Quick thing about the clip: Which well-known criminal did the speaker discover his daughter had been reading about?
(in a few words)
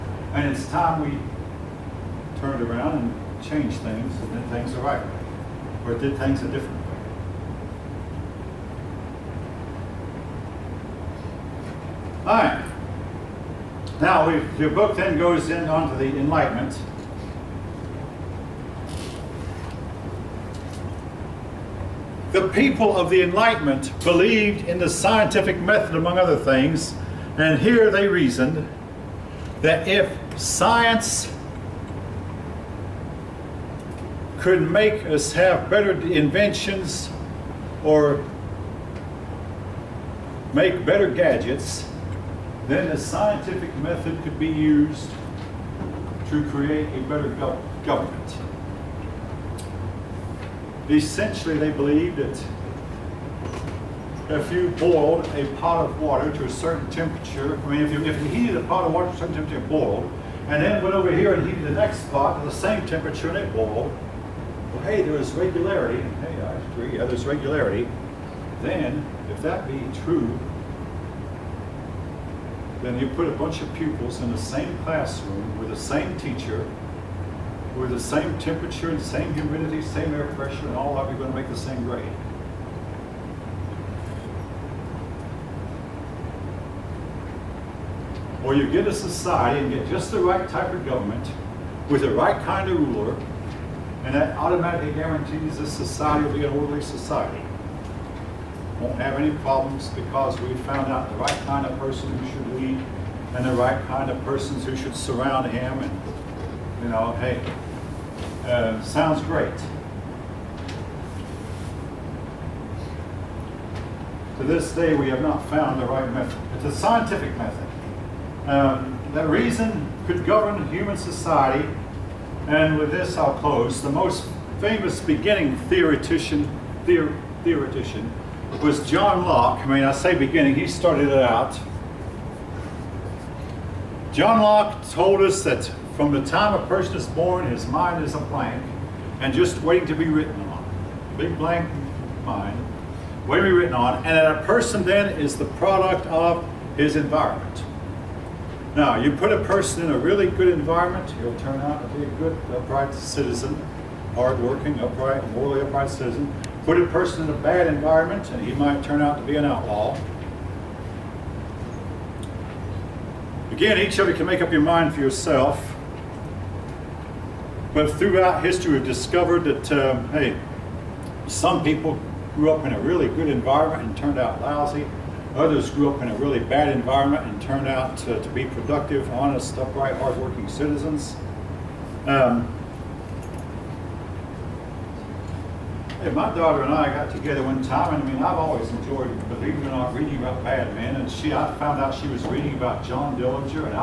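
John Dillinger.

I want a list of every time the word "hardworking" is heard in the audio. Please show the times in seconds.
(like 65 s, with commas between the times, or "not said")
154 s, 179 s.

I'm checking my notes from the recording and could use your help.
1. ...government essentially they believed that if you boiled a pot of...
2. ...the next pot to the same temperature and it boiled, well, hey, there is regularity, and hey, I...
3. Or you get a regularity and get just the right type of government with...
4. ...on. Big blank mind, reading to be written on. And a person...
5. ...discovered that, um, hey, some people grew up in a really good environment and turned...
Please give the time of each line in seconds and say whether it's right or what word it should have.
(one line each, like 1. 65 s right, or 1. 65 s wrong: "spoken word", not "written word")
1. 47 s right
2. 61 s right
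3. 88 s wrong: "society", not "regularity"
4. 140 s wrong: "waiting", not "reading"
5. 168 s right.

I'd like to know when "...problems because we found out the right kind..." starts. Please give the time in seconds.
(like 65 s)
99 s.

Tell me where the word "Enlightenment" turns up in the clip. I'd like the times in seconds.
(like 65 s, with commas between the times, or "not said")
16 s, 23 s.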